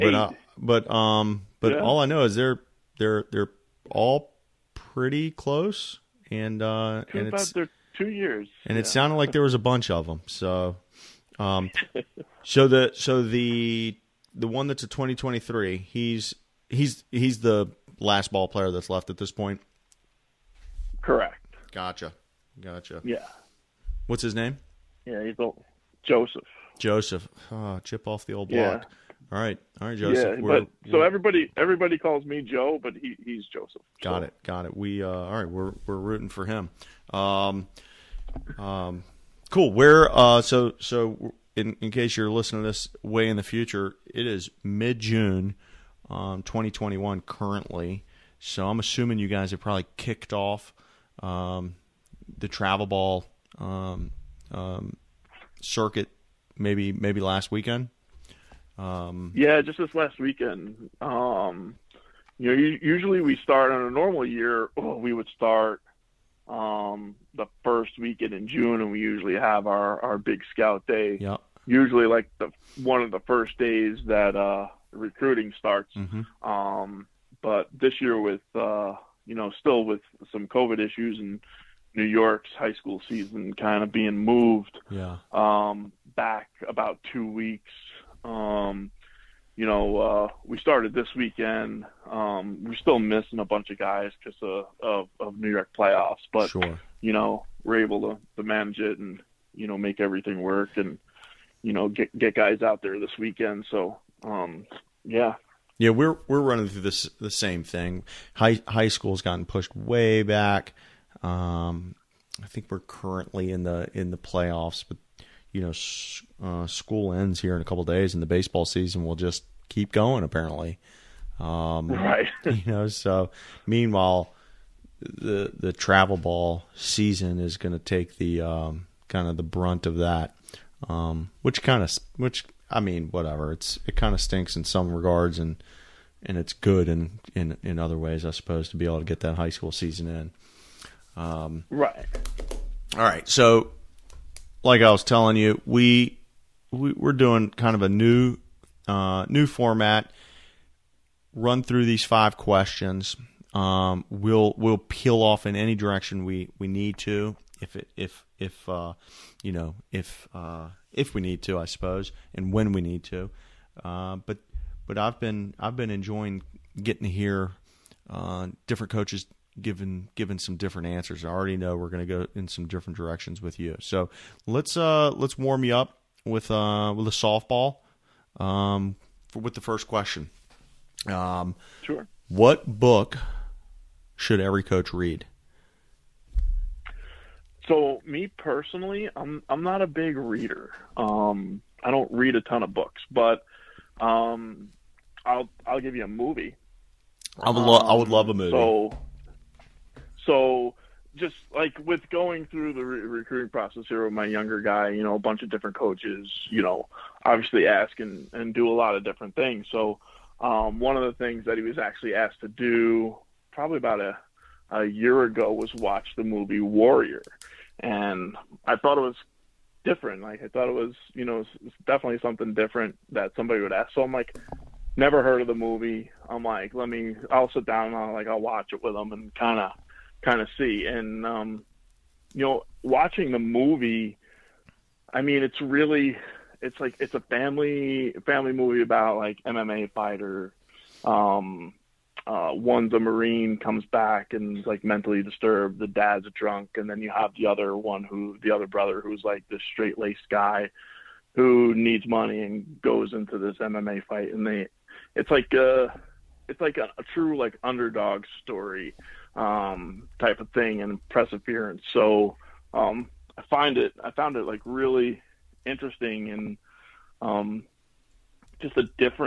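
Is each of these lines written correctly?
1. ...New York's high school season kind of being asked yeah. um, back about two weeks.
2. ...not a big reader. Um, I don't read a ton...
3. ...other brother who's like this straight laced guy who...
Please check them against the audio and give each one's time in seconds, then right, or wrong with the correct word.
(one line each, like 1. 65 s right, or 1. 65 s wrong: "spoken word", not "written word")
1. 81 s wrong: "moved", not "asked"
2. 189 s right
3. 248 s right.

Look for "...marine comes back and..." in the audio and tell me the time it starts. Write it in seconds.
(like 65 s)
242 s.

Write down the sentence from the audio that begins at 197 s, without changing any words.
I would lo- I would love a movie.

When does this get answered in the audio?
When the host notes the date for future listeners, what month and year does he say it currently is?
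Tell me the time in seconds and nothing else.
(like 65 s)
44 s.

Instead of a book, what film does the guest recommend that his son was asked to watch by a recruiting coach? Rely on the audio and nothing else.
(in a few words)
Warrior.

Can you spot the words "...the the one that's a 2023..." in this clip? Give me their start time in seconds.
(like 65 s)
13 s.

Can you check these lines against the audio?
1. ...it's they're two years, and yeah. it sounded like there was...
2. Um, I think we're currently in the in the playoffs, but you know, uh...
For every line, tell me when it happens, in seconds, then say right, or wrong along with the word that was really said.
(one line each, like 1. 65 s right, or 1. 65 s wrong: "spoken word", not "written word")
1. 7 s right
2. 111 s right.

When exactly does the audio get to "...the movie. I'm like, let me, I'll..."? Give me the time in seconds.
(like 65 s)
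225 s.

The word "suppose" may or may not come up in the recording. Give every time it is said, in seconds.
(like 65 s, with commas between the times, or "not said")
138 s, 161 s.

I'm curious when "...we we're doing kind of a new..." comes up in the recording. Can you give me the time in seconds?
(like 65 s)
146 s.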